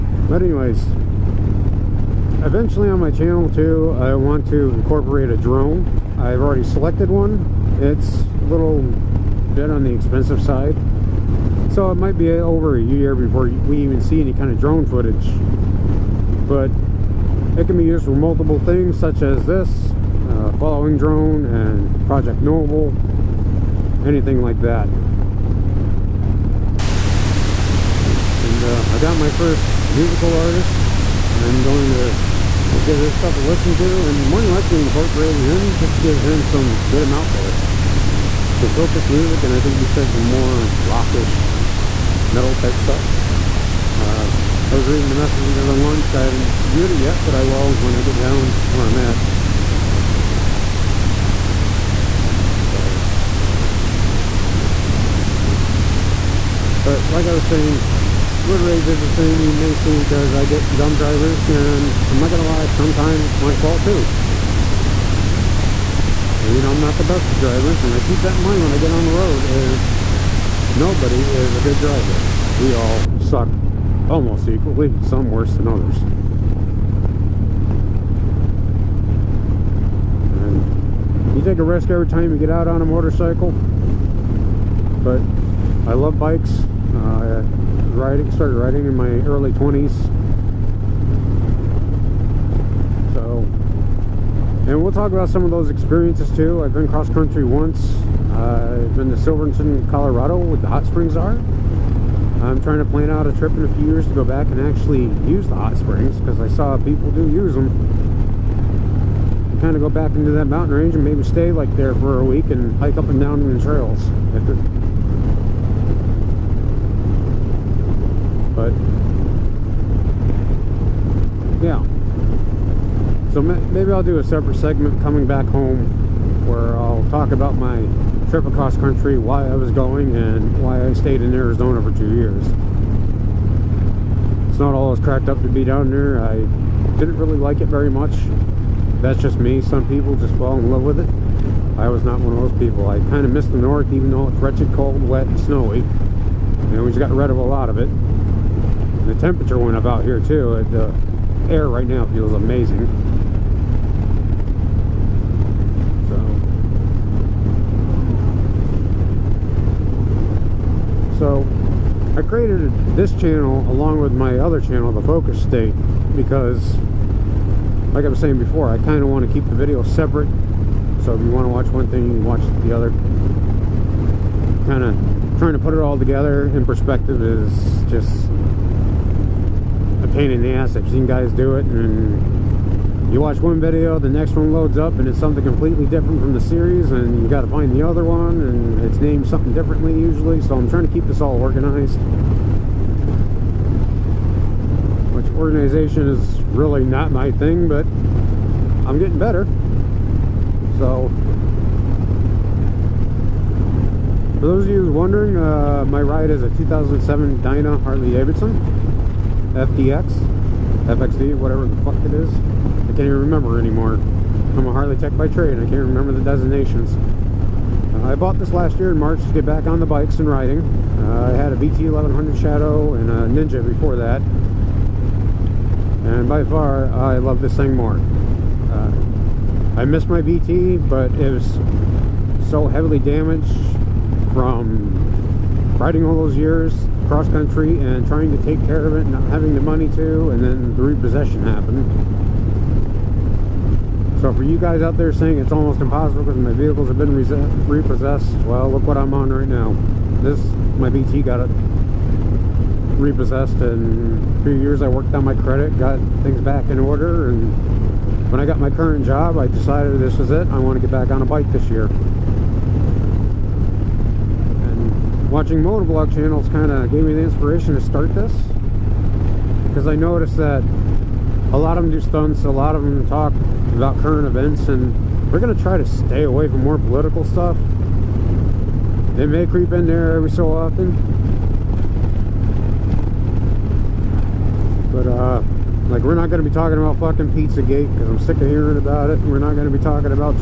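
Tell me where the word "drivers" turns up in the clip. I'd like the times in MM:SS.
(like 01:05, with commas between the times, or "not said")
01:00, 01:07, 01:11.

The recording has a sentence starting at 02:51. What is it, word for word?
So if you want to watch one thing, you watch the other.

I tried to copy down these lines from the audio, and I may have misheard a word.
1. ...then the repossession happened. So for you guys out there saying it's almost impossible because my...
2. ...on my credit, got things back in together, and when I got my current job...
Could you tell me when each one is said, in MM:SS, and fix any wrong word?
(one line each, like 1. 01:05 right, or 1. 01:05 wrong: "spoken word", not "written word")
1. 04:00 right
2. 04:15 wrong: "order", not "together".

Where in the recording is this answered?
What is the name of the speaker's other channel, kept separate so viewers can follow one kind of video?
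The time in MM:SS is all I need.
02:44.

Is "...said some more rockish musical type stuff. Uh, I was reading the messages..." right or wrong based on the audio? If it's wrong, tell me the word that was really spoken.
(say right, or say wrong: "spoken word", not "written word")
wrong: "metal", not "musical".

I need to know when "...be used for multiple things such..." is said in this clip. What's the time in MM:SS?
00:17.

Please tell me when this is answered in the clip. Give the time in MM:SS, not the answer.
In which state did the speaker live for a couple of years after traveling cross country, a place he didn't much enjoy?
02:11.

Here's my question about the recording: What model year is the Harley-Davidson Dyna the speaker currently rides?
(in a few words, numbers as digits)
2007.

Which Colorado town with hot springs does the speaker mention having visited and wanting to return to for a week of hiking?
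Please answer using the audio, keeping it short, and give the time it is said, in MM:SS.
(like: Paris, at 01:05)
Silverton, at 01:39.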